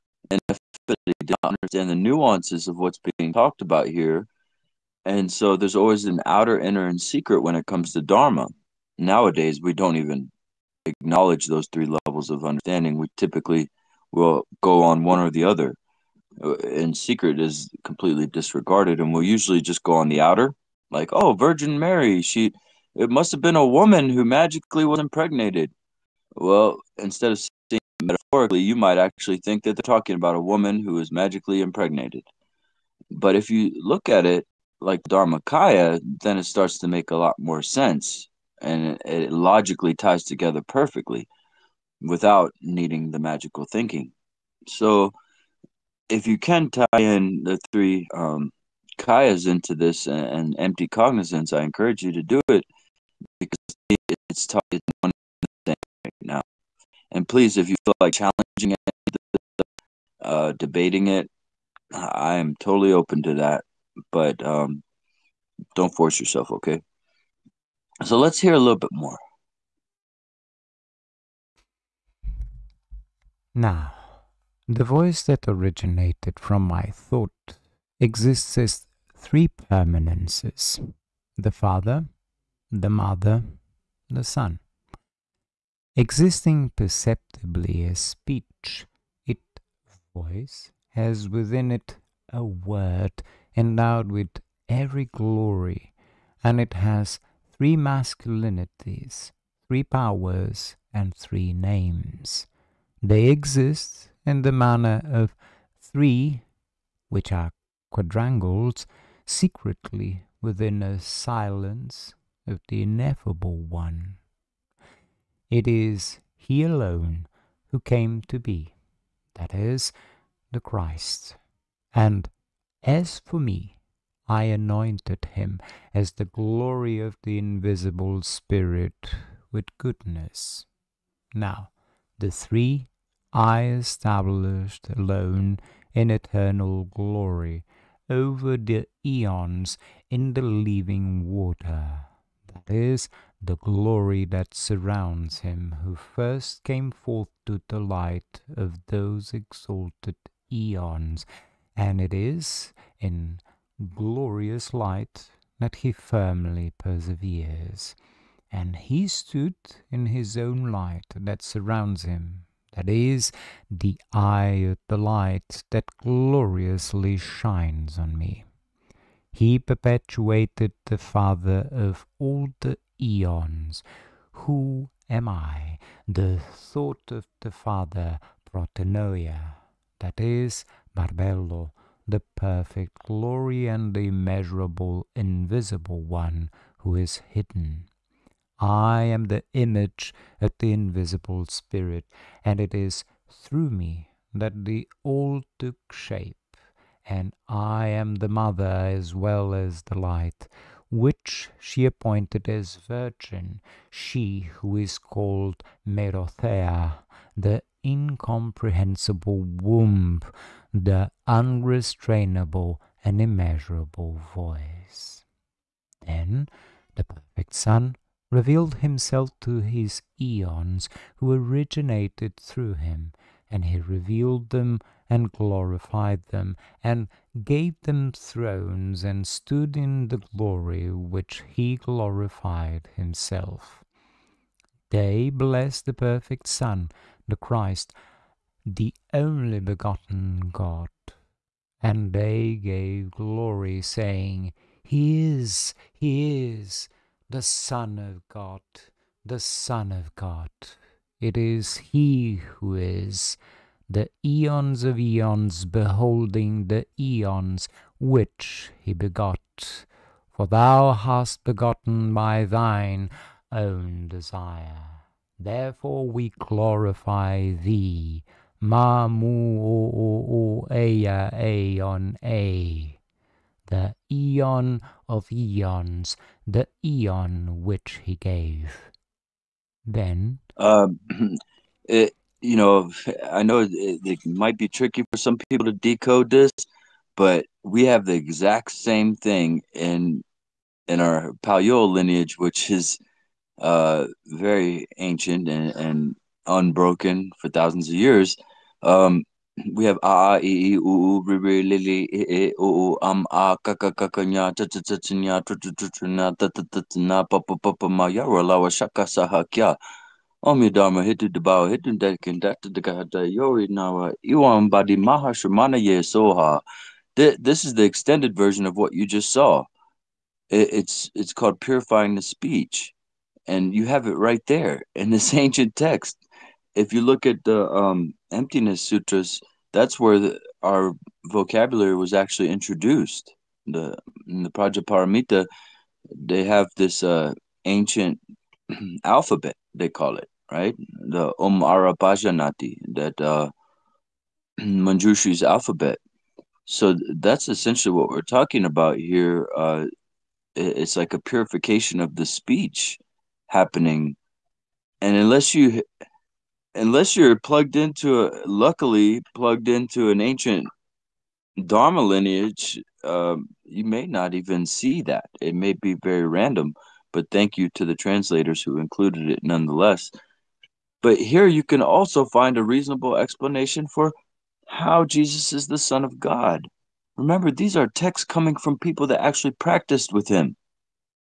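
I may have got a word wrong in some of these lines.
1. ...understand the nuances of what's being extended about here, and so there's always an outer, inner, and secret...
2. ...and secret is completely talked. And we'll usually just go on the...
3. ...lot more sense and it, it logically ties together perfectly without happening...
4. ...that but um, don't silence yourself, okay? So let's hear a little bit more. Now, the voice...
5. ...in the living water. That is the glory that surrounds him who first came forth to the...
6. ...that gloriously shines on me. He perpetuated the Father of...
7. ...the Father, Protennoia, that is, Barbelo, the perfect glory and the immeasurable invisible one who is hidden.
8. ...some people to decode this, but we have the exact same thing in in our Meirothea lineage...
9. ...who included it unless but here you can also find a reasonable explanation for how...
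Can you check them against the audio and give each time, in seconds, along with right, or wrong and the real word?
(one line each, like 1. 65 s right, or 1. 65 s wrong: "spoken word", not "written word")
1. 1 s wrong: "talked", not "extended"
2. 16 s wrong: "disregarded", not "talked"
3. 37 s wrong: "needing", not "happening"
4. 63 s wrong: "force", not "silence"
5. 140 s right
6. 165 s right
7. 177 s right
8. 285 s wrong: "Paleo", not "Meirothea"
9. 368 s wrong: "nonetheless", not "unless".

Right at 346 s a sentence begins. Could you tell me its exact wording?
So that's essentially what we're talking about here.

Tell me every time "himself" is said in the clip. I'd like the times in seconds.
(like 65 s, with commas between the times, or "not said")
218 s, 232 s.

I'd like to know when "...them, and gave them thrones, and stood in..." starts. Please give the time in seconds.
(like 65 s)
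226 s.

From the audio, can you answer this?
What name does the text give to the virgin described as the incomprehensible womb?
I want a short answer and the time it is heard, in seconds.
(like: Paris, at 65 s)
Meirothea, at 205 s.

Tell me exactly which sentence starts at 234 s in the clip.
They blessed the perfect Son, the Christ, the only begotten God.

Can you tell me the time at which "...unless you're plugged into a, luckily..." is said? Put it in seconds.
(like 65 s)
356 s.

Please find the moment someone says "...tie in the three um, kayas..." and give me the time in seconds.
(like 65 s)
46 s.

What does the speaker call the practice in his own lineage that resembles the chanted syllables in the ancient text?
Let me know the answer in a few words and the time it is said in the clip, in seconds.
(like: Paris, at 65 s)
Purifying the speech, at 321 s.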